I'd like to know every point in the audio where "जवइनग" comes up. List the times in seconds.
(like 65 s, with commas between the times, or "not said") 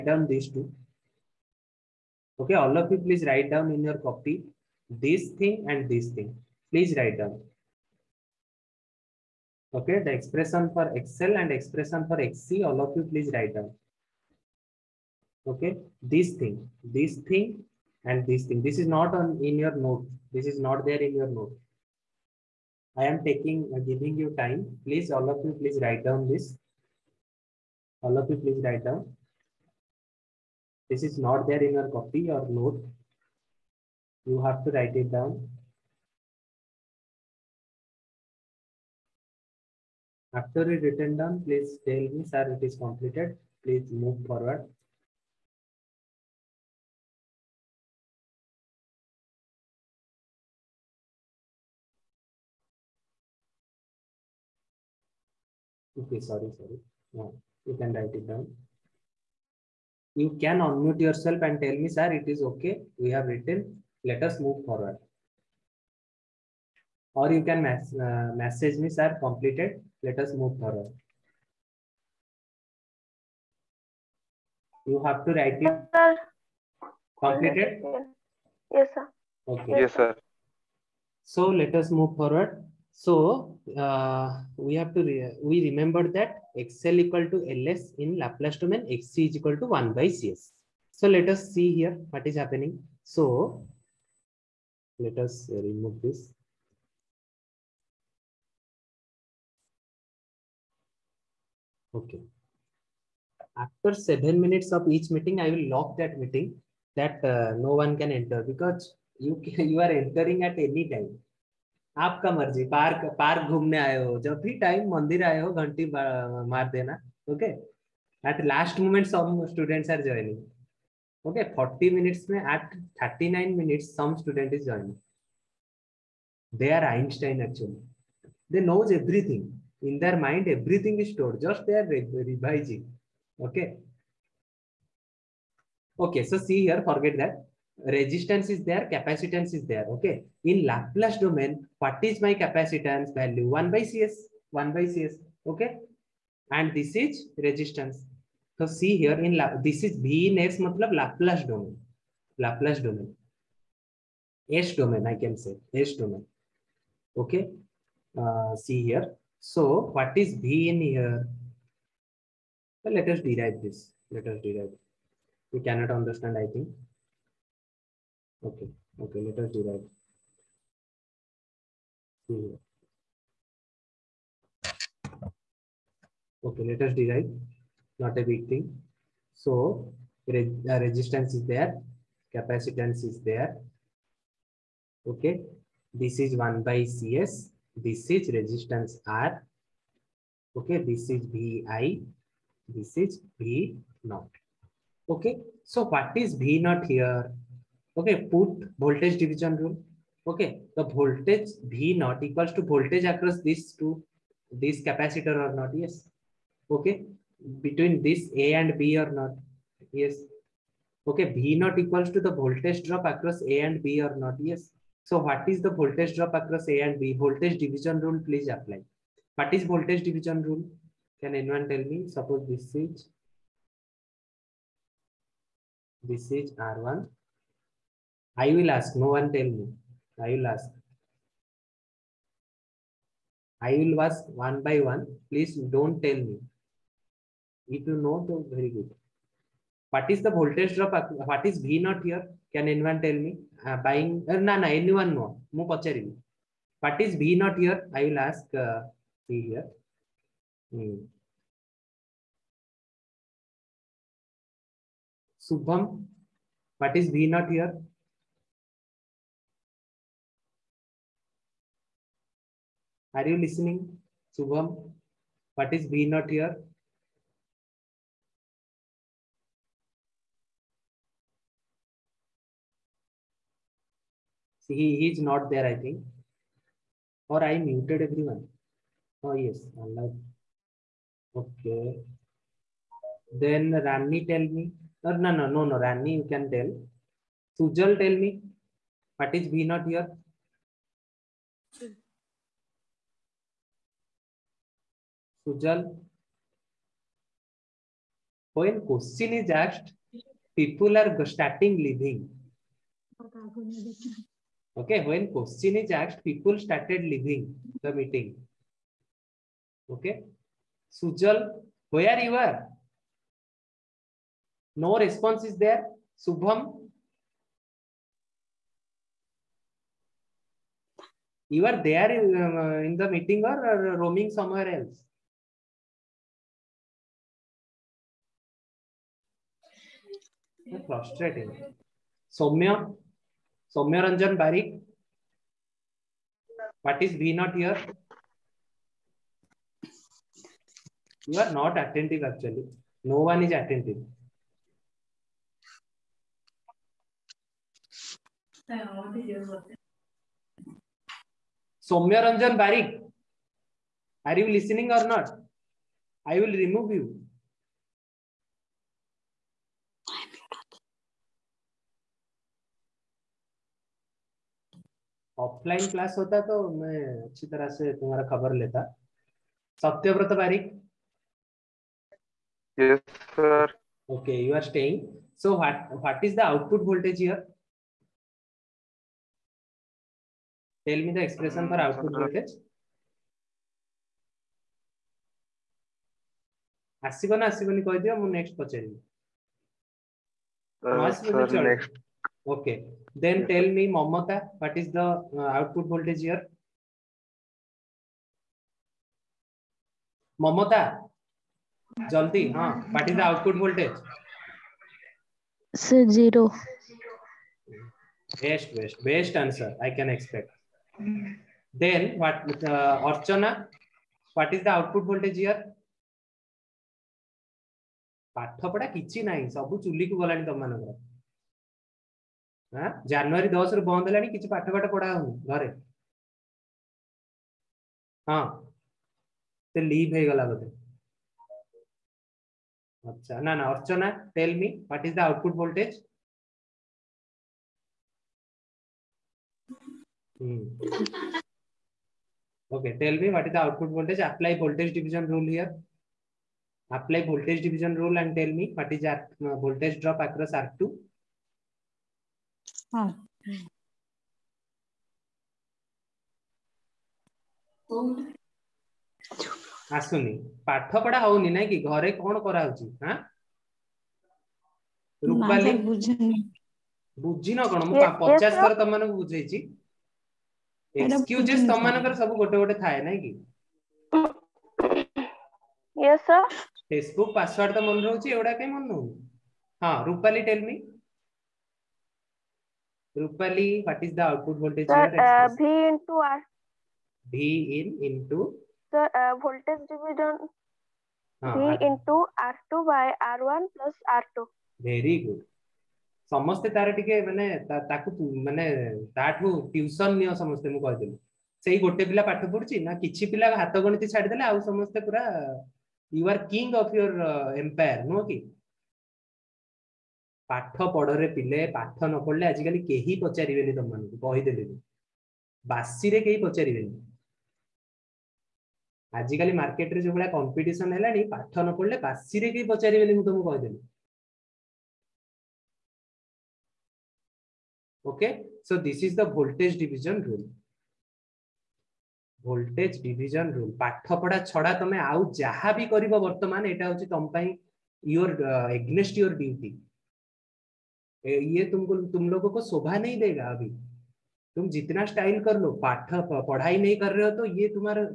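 120 s, 124 s.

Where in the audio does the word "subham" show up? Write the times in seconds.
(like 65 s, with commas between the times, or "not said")
255 s, 264 s, 316 s.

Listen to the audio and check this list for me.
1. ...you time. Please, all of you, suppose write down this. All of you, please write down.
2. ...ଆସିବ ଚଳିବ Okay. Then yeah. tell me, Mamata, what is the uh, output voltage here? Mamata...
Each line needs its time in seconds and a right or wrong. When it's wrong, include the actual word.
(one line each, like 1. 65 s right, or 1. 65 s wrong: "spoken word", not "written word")
1. 24 s wrong: "please", not "suppose"
2. 391 s right.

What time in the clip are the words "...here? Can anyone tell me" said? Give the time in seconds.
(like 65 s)
242 s.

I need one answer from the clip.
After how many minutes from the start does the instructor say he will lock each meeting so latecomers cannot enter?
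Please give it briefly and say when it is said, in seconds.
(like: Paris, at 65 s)
7, at 103 s.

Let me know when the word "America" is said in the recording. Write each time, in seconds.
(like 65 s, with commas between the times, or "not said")
not said.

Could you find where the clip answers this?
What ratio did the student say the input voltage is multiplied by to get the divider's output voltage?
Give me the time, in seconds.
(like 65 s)
492 s.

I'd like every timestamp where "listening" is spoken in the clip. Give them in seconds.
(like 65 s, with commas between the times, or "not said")
263 s, 354 s.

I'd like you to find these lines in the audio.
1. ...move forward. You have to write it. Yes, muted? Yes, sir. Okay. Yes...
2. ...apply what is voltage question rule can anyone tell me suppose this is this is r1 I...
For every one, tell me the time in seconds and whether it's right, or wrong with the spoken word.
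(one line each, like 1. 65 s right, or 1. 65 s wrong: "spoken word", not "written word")
1. 70 s wrong: "completed", not "muted"
2. 218 s wrong: "division", not "question".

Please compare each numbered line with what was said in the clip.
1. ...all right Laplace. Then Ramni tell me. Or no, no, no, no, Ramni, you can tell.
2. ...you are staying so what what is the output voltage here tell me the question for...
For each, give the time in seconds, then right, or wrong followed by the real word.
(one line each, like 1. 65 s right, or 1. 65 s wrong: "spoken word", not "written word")
1. 279 s wrong: "Okay", not "Laplace"
2. 374 s wrong: "expression", not "question".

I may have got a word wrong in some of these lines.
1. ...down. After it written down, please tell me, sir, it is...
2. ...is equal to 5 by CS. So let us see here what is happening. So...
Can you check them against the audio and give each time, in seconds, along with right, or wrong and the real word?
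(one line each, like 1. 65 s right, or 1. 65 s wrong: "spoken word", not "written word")
1. 35 s right
2. 89 s wrong: "1", not "5".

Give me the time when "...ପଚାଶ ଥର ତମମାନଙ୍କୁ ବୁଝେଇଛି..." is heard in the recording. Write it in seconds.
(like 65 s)
468 s.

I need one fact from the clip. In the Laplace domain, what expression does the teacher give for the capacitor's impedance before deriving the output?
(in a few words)
1 by Cs.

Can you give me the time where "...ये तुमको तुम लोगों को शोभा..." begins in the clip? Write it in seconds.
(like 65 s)
541 s.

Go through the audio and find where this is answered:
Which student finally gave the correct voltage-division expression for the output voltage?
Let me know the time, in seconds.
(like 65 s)
483 s.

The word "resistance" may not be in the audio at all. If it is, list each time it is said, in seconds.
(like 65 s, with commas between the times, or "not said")
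137 s, 147 s, 180 s, 188 s.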